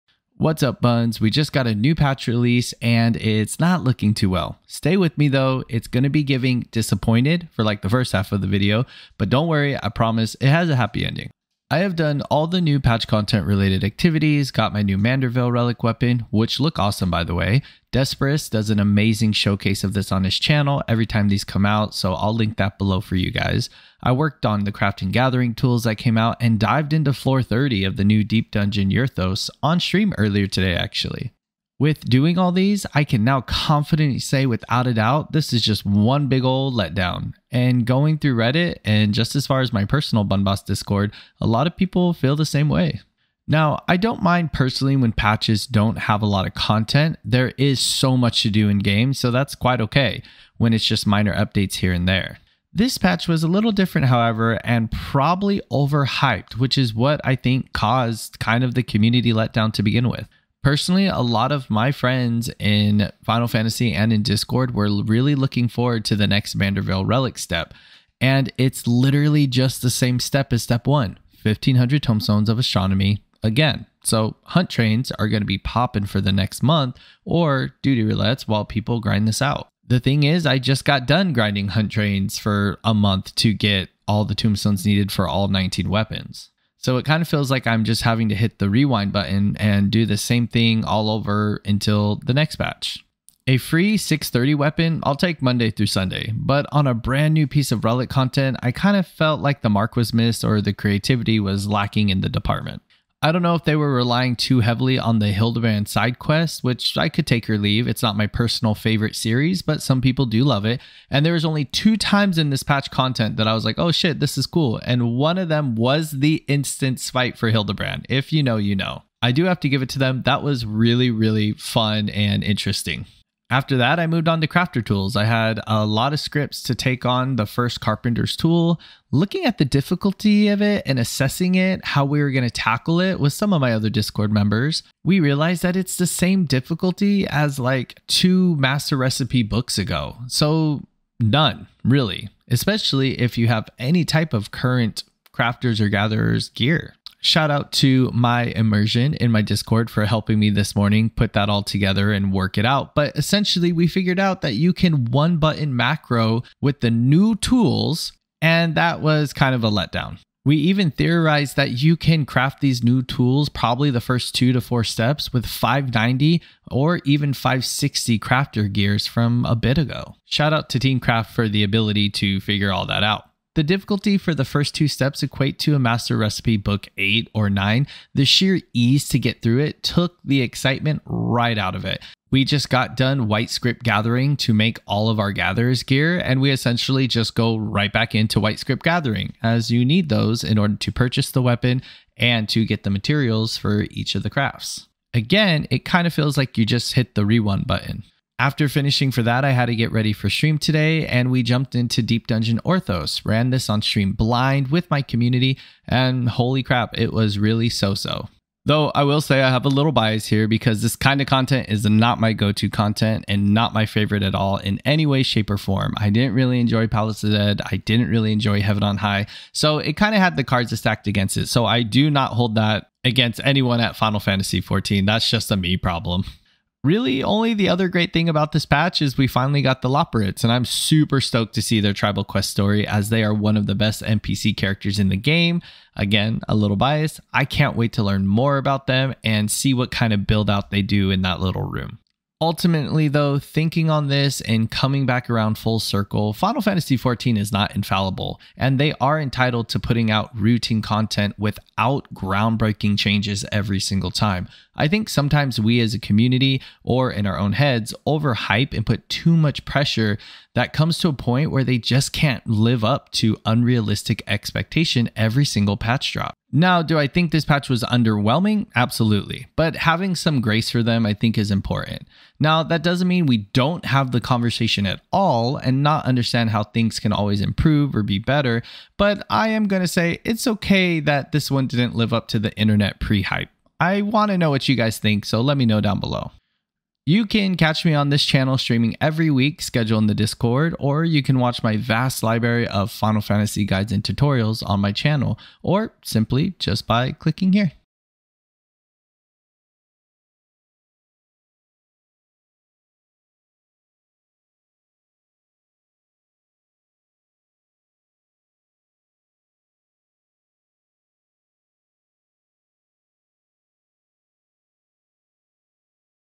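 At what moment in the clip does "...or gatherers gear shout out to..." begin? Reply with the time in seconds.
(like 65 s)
145 s.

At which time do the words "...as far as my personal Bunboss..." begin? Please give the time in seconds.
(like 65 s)
39 s.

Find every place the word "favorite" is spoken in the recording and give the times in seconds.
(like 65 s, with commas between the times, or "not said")
108 s, 213 s.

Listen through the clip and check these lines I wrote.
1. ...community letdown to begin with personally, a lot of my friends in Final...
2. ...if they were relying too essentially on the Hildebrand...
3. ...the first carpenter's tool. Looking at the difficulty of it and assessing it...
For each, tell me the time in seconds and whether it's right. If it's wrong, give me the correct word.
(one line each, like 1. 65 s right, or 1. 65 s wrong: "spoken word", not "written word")
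1. 58 s right
2. 103 s wrong: "heavily", not "essentially"
3. 127 s right.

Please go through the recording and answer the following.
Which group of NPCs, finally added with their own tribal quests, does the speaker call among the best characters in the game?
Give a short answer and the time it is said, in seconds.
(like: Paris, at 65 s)
Loporrits, at 229 s.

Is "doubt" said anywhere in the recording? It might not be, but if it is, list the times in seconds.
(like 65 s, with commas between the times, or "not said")
34 s.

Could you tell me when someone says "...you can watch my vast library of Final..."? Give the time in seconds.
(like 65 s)
291 s.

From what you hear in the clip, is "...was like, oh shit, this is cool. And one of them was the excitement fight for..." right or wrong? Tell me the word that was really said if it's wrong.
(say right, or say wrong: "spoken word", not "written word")
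wrong: "instant", not "excitement".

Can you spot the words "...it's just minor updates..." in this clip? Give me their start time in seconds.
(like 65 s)
50 s.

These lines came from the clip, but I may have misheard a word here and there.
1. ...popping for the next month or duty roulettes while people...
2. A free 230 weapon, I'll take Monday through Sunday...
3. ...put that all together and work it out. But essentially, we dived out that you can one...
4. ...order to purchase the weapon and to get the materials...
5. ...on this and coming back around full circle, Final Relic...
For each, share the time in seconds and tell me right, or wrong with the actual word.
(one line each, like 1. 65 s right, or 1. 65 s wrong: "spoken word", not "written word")
1. 75 s right
2. 93 s wrong: "630", not "230"
3. 151 s wrong: "figured", not "dived"
4. 190 s right
5. 243 s wrong: "Fantasy", not "Relic".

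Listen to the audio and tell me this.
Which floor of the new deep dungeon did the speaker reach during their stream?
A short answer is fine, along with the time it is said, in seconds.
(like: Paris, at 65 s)
30, at 27 s.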